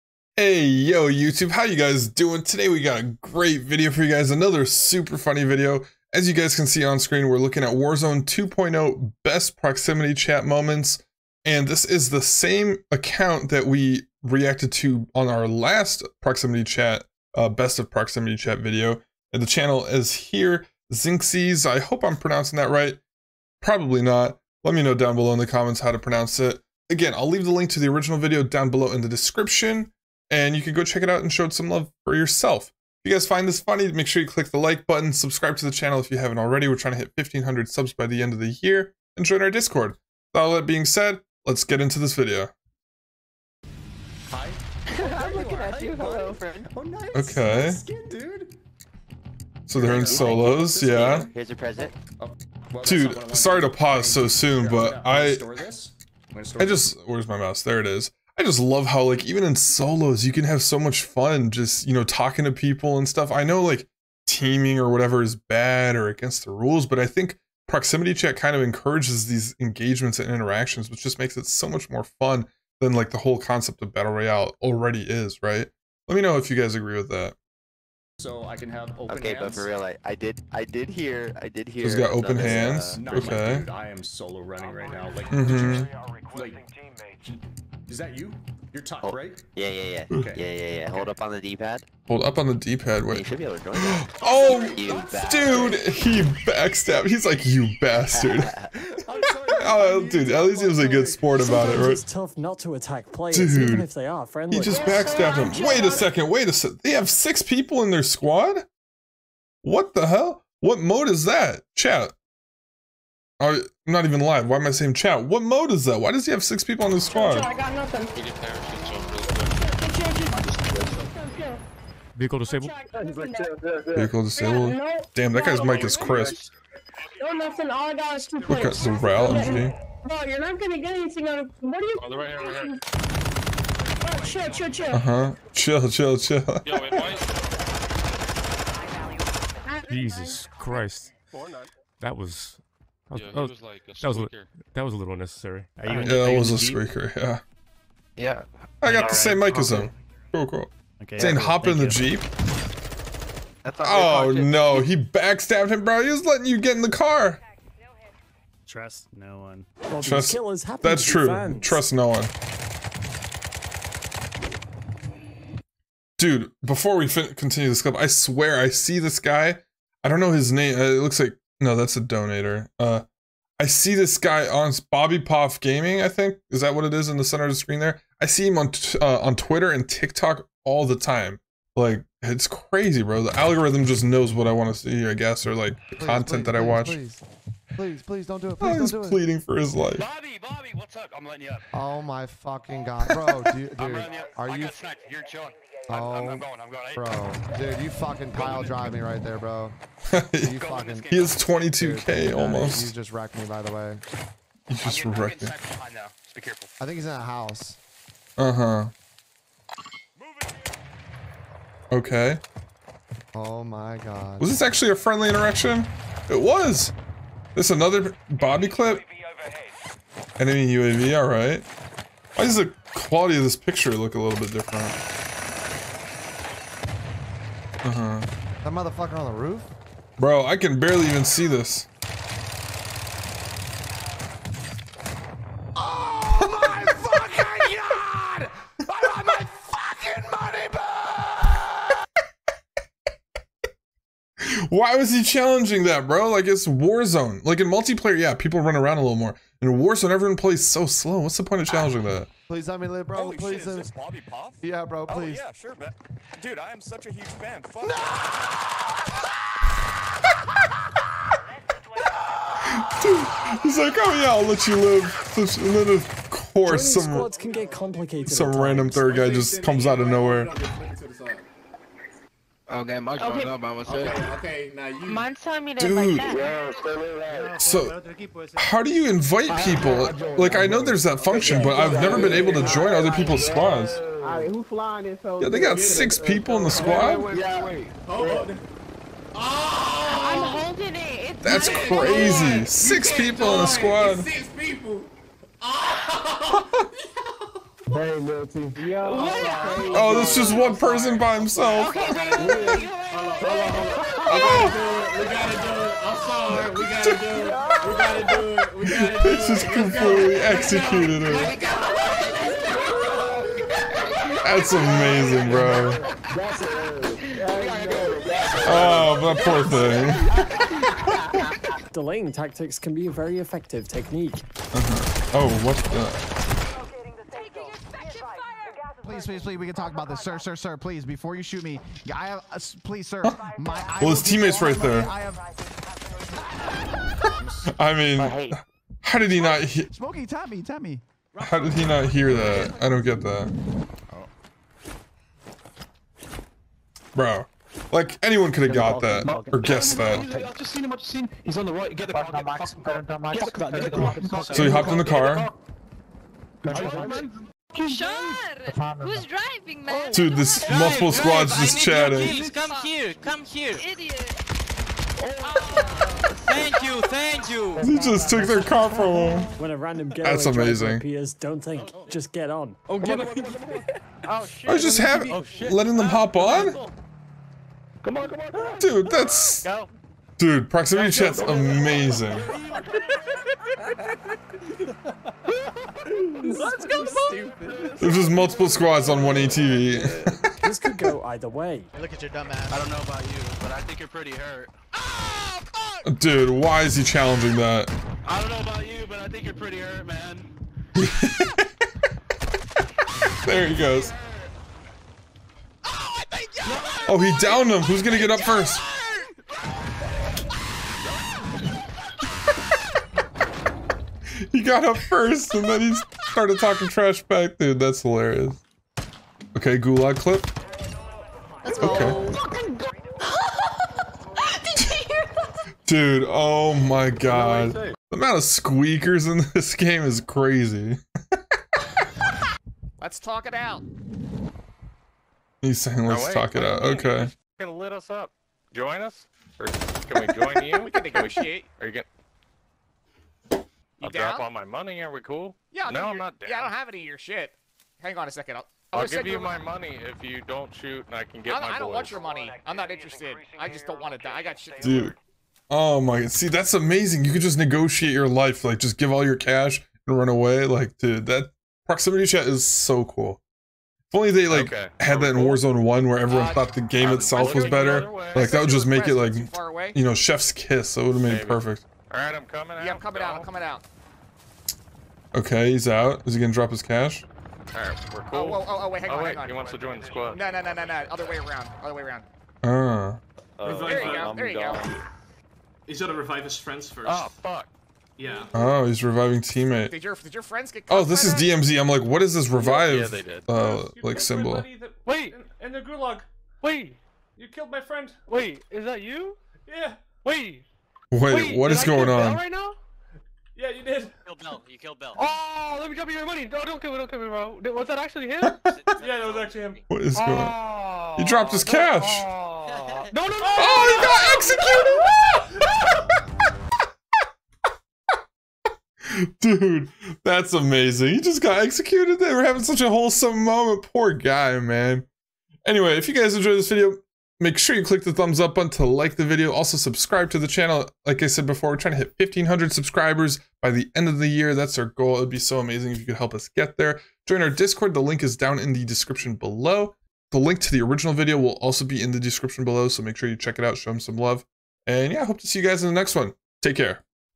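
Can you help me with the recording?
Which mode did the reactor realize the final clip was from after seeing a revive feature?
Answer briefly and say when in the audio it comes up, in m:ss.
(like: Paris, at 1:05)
DMZ, at 8:11.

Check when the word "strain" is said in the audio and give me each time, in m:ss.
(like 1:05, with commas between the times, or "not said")
not said.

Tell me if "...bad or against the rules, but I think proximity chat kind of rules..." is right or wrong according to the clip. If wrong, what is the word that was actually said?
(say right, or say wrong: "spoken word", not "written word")
wrong: "encourages", not "rules".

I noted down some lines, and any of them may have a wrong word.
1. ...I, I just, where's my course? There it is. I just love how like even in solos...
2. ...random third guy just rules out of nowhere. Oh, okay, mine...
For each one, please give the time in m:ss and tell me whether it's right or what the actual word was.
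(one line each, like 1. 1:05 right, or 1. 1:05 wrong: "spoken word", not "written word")
1. 0:55 wrong: "mouse", not "course"
2. 4:28 wrong: "comes", not "rules".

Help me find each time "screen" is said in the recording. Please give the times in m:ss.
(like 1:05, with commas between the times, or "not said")
0:06, 2:57.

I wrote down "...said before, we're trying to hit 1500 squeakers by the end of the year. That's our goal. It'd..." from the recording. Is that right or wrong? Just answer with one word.
wrong.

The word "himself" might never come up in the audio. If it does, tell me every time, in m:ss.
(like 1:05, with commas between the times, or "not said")
5:01.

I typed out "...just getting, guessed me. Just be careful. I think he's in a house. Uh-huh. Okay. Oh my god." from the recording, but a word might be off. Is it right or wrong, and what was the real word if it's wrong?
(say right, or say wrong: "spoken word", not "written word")
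wrong: "wrecked", not "guessed".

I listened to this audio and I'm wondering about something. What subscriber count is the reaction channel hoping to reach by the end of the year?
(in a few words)
1500.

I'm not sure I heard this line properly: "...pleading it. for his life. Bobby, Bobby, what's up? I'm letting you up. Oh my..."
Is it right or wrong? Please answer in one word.
right.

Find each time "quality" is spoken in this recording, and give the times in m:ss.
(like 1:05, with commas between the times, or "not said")
3:42.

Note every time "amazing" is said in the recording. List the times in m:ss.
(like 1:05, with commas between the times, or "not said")
5:14, 6:10, 6:21, 7:36, 8:40, 8:55.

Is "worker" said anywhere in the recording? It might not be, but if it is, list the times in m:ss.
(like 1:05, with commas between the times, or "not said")
not said.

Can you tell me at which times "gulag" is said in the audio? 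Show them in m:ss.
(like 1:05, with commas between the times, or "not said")
6:59, 8:15.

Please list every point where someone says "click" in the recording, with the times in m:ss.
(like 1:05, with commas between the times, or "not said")
0:34, 8:47.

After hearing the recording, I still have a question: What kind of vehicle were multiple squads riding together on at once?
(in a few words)
ATV.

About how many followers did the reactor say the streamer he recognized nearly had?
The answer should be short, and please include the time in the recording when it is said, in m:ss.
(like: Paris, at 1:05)
22k, at 3:21.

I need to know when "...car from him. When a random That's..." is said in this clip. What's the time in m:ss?
6:08.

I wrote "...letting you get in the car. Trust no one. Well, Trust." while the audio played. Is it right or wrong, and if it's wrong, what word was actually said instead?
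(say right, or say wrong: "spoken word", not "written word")
right.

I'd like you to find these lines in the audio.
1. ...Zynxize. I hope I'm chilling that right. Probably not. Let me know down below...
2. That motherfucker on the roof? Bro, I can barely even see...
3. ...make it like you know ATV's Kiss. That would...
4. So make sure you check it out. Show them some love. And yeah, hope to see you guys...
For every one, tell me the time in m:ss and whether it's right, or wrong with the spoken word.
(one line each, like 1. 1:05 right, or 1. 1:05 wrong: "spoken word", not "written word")
1. 0:20 wrong: "pronouncing", not "chilling"
2. 3:48 right
3. 7:48 wrong: "Chef", not "ATV"
4. 9:02 right.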